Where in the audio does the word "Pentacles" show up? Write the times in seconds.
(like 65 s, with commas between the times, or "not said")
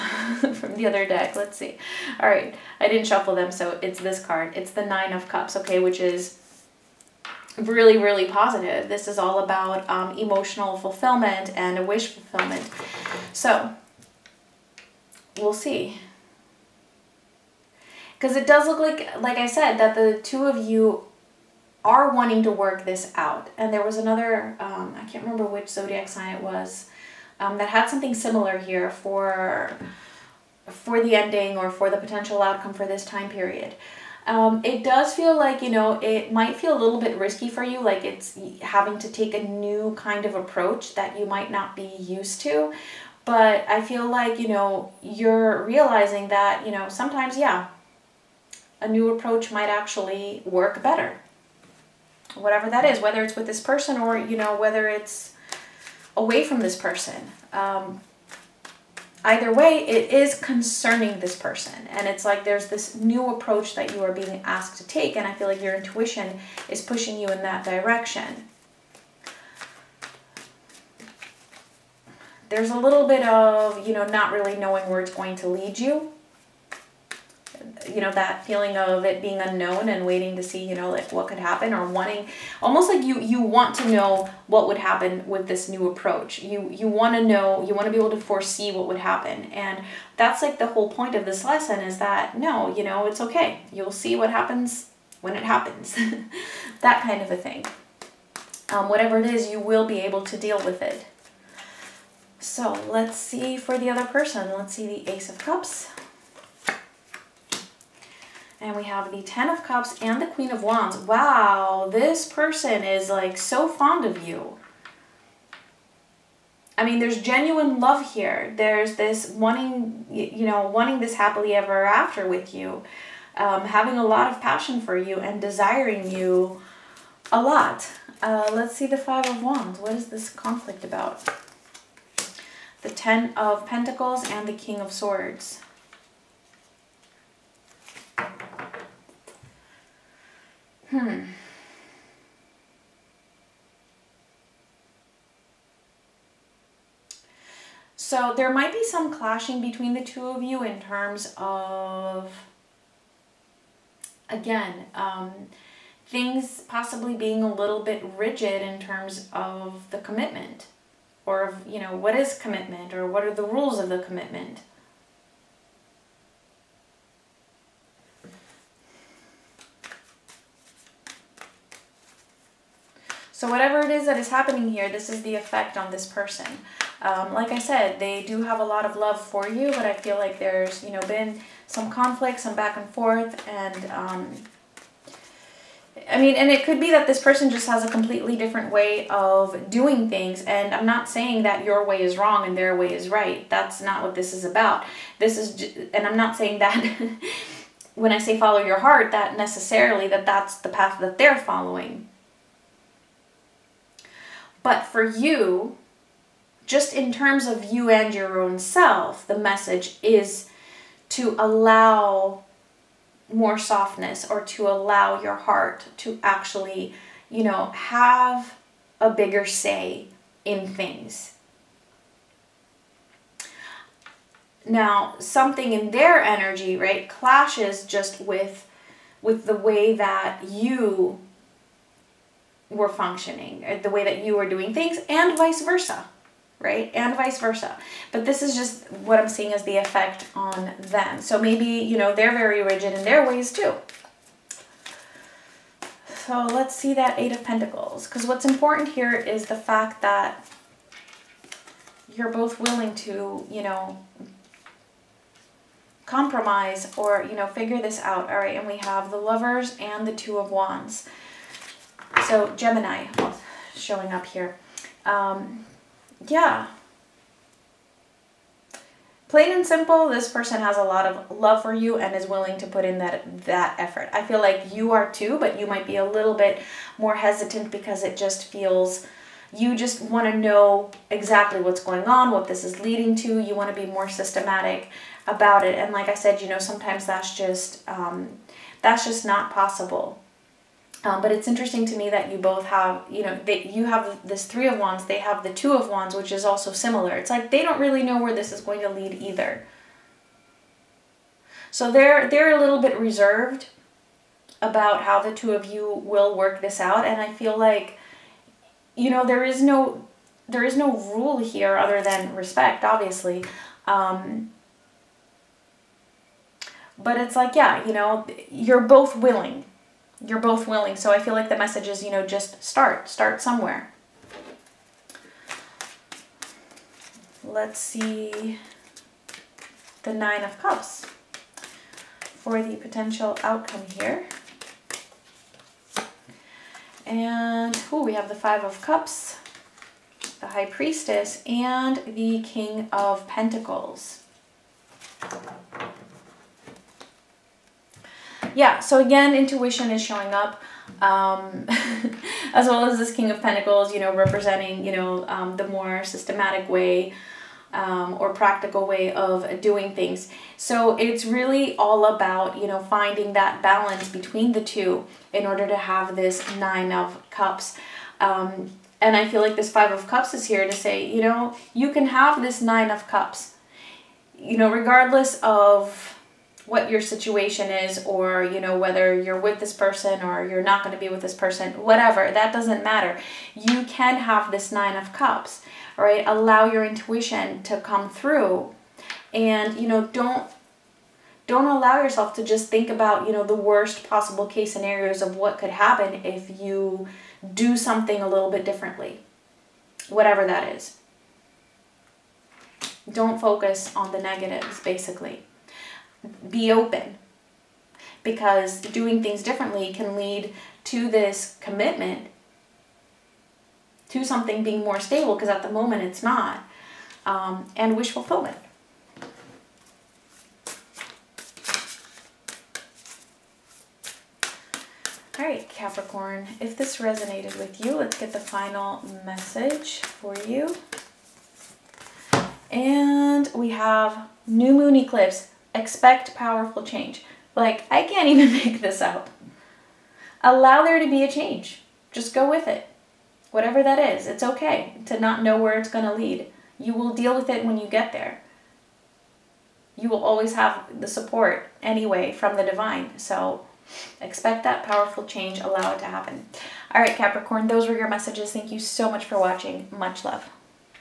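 133 s, 247 s, 343 s, 353 s.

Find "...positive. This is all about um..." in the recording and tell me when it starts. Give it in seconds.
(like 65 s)
8 s.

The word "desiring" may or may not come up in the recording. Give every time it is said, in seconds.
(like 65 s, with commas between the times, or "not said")
125 s.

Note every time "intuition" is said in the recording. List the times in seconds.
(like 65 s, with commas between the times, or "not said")
65 s, 349 s, 386 s.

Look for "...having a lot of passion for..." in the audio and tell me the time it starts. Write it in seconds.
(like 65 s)
123 s.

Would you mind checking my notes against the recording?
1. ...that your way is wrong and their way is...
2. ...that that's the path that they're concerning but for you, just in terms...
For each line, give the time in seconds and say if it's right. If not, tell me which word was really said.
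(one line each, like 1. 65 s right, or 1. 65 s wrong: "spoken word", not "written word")
1. 191 s right
2. 200 s wrong: "following", not "concerning".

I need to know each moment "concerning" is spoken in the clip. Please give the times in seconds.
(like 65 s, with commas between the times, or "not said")
60 s.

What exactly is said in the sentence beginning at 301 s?
So they're, they're a little bit reserved about how the two of you will work this out.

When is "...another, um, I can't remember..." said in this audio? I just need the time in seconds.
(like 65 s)
23 s.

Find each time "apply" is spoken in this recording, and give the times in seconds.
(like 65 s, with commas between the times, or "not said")
not said.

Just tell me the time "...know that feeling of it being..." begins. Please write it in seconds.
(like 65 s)
77 s.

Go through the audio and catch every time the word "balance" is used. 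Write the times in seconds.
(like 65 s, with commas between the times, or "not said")
363 s.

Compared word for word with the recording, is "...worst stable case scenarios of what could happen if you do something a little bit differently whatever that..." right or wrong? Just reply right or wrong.
wrong.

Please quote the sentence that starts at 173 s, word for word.
So whatever it is that is happening here, this is the effect on this person.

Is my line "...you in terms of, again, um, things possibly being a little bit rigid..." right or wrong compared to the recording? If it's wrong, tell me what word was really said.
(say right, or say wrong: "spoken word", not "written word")
right.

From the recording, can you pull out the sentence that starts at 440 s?
Allow there to be a change.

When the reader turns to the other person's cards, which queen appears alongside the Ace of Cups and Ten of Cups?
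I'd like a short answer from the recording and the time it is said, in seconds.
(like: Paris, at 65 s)
Queen of Wands, at 110 s.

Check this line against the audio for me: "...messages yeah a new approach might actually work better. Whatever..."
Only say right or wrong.
wrong.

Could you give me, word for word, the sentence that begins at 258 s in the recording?
All right, and we have the Lovers and the Two of Wands.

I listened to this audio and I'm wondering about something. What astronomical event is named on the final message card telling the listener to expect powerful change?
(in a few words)
New moon eclipse.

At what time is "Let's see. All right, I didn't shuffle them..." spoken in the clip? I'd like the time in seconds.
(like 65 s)
1 s.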